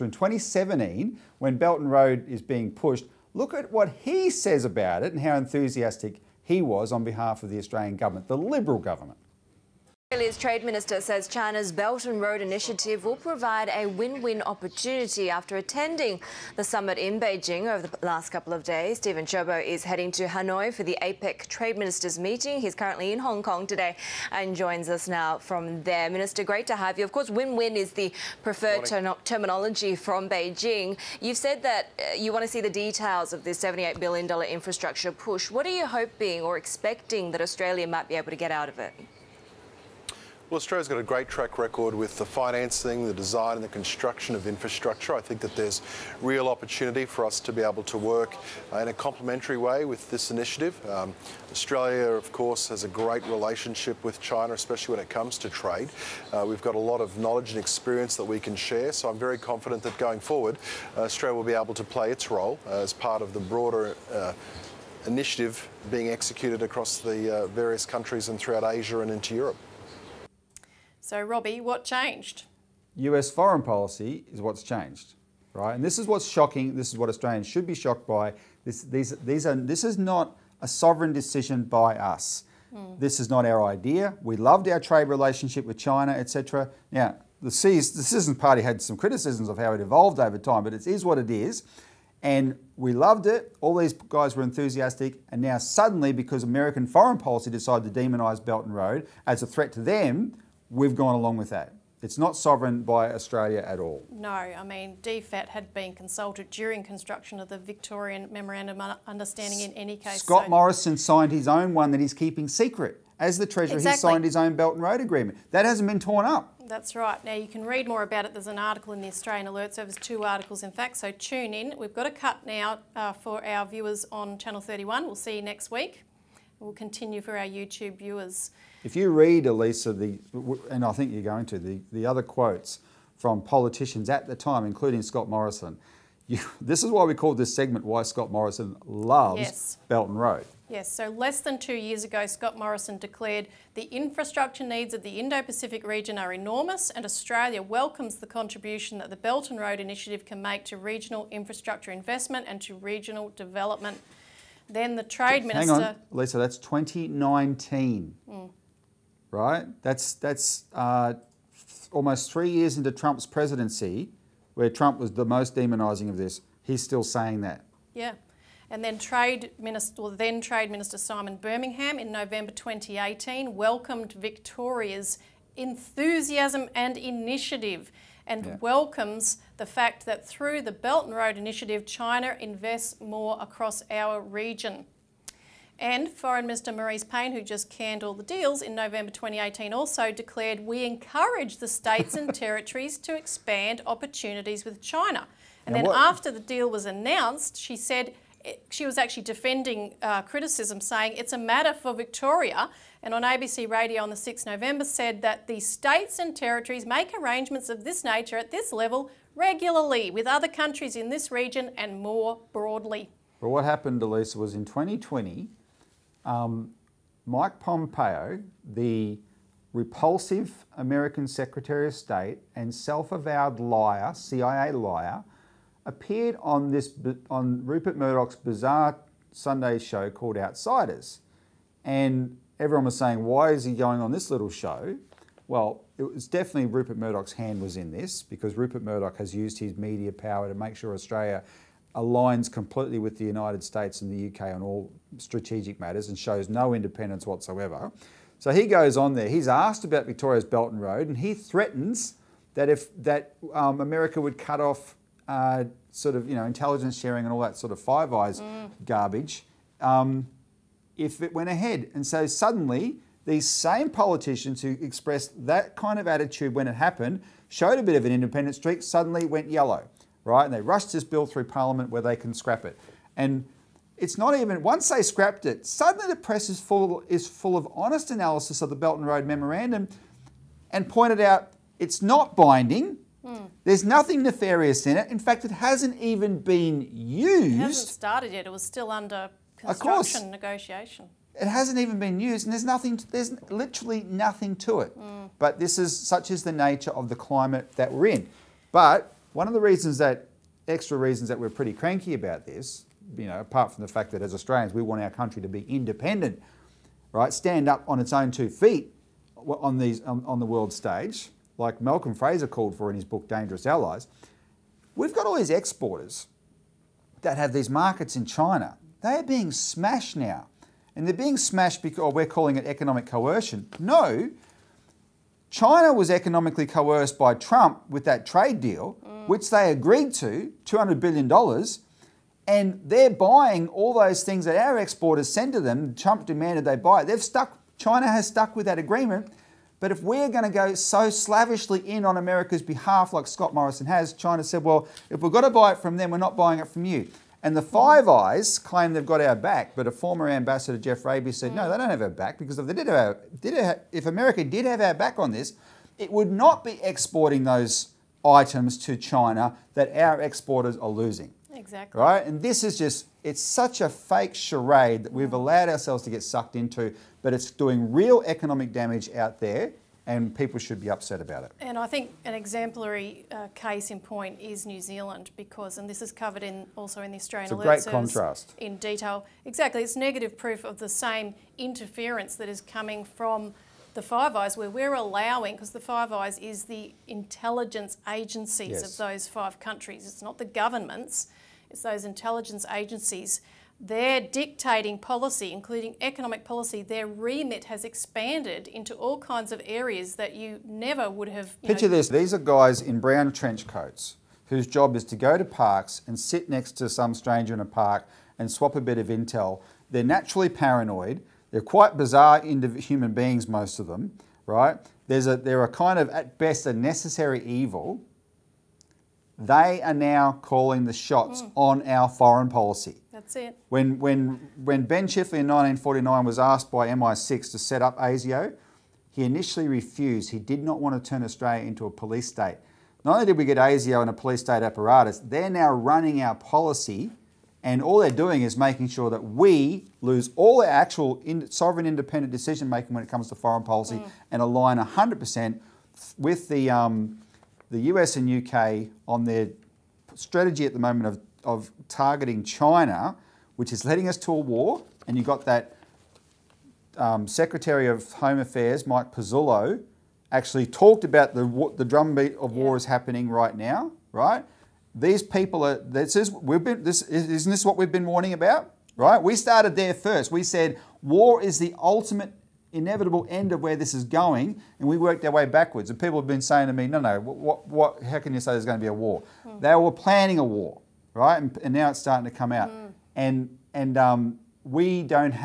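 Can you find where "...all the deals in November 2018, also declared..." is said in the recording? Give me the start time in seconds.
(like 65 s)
188 s.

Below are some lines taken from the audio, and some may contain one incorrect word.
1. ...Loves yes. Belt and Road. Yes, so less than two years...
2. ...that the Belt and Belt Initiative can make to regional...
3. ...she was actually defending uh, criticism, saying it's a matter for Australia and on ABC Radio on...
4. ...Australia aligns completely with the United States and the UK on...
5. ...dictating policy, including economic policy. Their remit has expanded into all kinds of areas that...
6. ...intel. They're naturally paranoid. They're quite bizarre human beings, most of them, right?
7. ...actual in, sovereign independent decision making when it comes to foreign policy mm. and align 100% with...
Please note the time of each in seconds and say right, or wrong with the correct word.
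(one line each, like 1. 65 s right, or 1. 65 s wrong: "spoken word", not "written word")
1. 138 s right
2. 148 s wrong: "Road", not "Belt"
3. 198 s wrong: "Victoria", not "Australia"
4. 240 s right
5. 394 s right
6. 409 s right
7. 440 s right.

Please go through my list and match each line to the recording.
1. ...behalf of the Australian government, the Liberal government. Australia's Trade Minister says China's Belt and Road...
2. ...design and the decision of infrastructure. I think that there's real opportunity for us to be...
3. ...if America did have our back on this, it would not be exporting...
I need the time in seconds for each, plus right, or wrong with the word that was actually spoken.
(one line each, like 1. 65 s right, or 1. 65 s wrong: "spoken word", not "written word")
1. 7 s right
2. 43 s wrong: "construction", not "decision"
3. 353 s right.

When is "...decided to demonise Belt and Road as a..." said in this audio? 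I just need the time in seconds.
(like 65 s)
97 s.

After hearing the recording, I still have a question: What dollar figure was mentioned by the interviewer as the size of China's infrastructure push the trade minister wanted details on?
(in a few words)
$78 billion.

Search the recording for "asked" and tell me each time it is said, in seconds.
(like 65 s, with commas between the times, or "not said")
249 s, 426 s.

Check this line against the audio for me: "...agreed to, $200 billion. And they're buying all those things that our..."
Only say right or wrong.
right.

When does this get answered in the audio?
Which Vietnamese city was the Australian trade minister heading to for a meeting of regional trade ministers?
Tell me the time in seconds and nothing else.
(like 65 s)
20 s.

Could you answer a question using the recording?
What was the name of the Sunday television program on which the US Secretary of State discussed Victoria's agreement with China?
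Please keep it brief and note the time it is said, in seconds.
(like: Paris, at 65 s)
Outsiders, at 230 s.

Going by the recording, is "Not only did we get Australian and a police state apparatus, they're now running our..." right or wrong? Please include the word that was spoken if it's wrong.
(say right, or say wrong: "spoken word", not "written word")
wrong: "ASIO", not "Australian".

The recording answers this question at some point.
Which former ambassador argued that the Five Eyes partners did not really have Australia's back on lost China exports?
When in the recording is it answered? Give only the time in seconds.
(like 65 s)
350 s.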